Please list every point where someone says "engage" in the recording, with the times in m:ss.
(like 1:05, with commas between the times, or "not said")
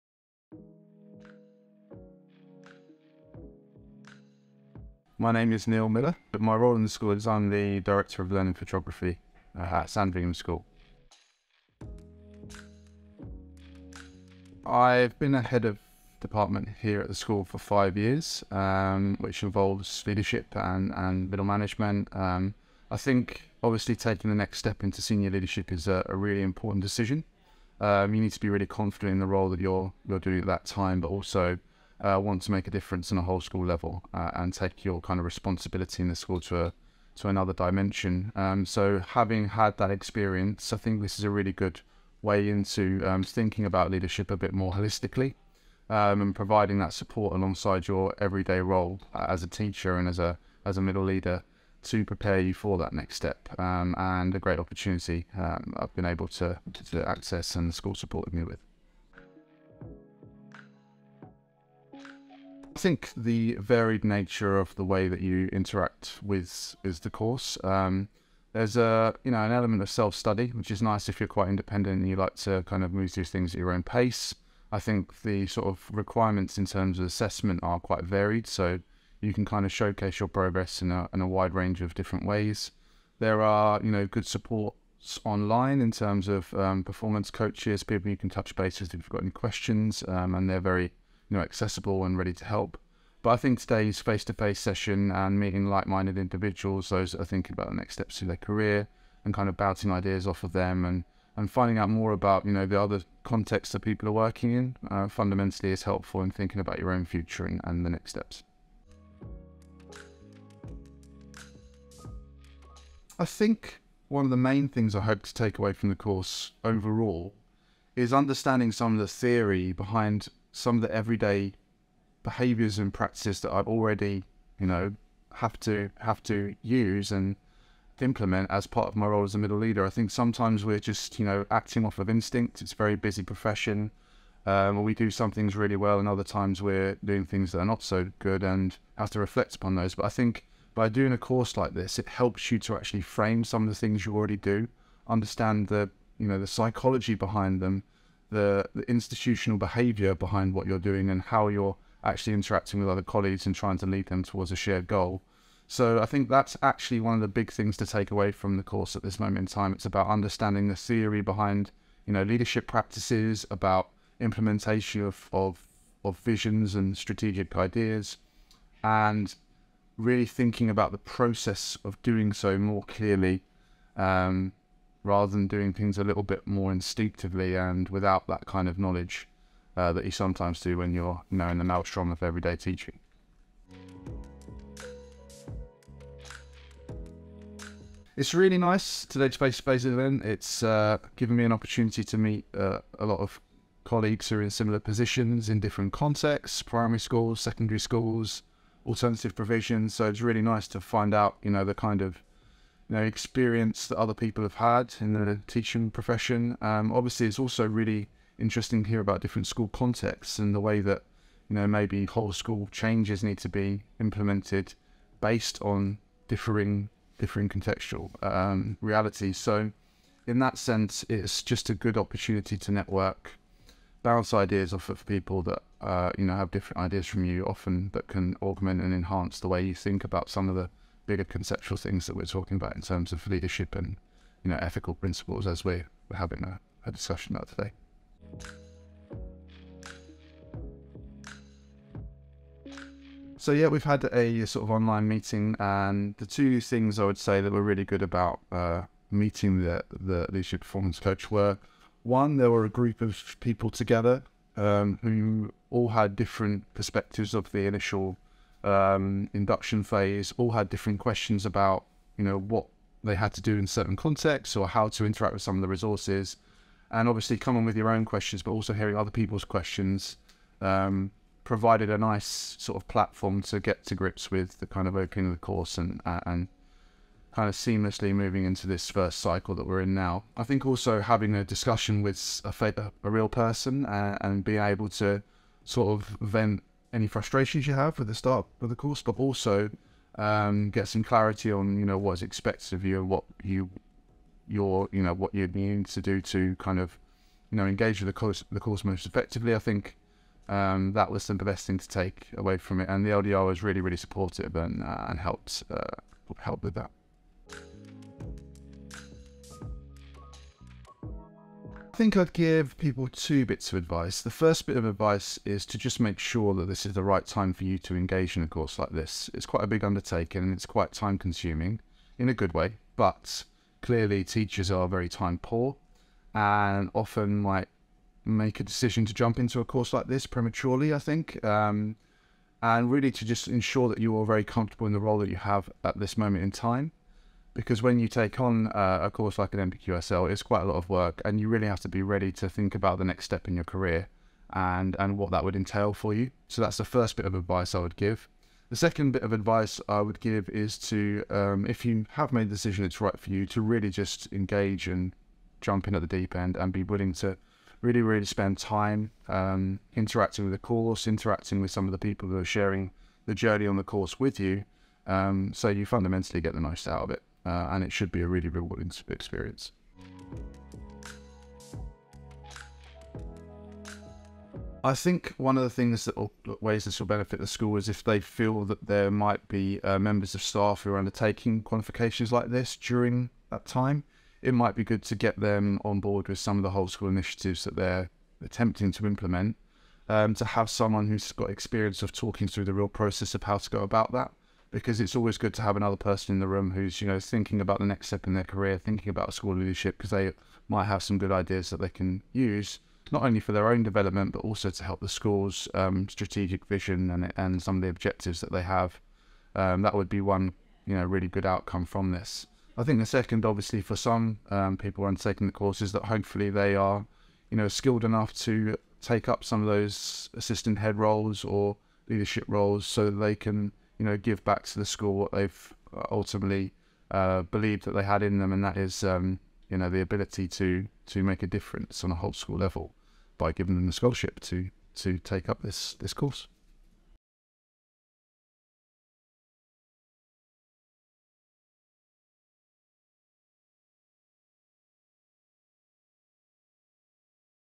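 4:57, 5:17, 5:54.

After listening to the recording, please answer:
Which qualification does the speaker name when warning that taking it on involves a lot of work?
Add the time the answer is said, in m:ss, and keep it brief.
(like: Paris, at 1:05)
NPQSL, at 5:39.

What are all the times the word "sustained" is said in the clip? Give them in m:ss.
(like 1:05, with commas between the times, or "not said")
not said.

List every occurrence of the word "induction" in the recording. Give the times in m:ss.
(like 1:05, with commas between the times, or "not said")
4:19.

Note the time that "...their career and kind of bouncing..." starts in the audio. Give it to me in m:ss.
1:38.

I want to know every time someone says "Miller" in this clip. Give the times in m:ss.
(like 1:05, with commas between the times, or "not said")
0:05.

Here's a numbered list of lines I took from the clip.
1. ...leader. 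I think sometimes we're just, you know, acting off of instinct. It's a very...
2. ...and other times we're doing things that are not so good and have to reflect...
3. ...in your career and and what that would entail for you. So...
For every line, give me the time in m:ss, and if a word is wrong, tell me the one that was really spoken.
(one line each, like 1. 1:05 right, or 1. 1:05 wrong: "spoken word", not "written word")
1. 2:09 right
2. 2:15 right
3. 5:43 right.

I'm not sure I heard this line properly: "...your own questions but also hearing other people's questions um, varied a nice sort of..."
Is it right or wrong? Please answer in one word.
wrong.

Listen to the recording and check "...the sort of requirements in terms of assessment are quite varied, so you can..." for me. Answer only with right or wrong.
right.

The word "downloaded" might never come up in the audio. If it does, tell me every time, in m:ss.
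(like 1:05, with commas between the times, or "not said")
not said.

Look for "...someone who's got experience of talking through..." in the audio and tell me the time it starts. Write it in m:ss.
6:30.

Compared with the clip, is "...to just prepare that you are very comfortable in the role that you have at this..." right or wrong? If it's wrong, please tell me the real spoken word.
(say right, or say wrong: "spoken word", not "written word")
wrong: "ensure", not "prepare".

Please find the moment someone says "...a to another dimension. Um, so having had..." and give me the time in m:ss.
0:36.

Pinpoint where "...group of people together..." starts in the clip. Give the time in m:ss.
4:12.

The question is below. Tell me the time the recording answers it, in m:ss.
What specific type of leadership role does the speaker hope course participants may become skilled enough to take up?
7:00.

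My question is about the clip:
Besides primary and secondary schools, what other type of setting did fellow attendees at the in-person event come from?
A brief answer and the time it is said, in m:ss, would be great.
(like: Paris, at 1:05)
Alternative provisions, at 3:18.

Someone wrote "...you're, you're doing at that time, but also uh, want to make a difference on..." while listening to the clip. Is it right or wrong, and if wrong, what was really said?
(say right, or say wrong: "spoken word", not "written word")
right.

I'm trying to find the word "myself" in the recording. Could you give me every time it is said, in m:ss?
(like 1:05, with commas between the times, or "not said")
not said.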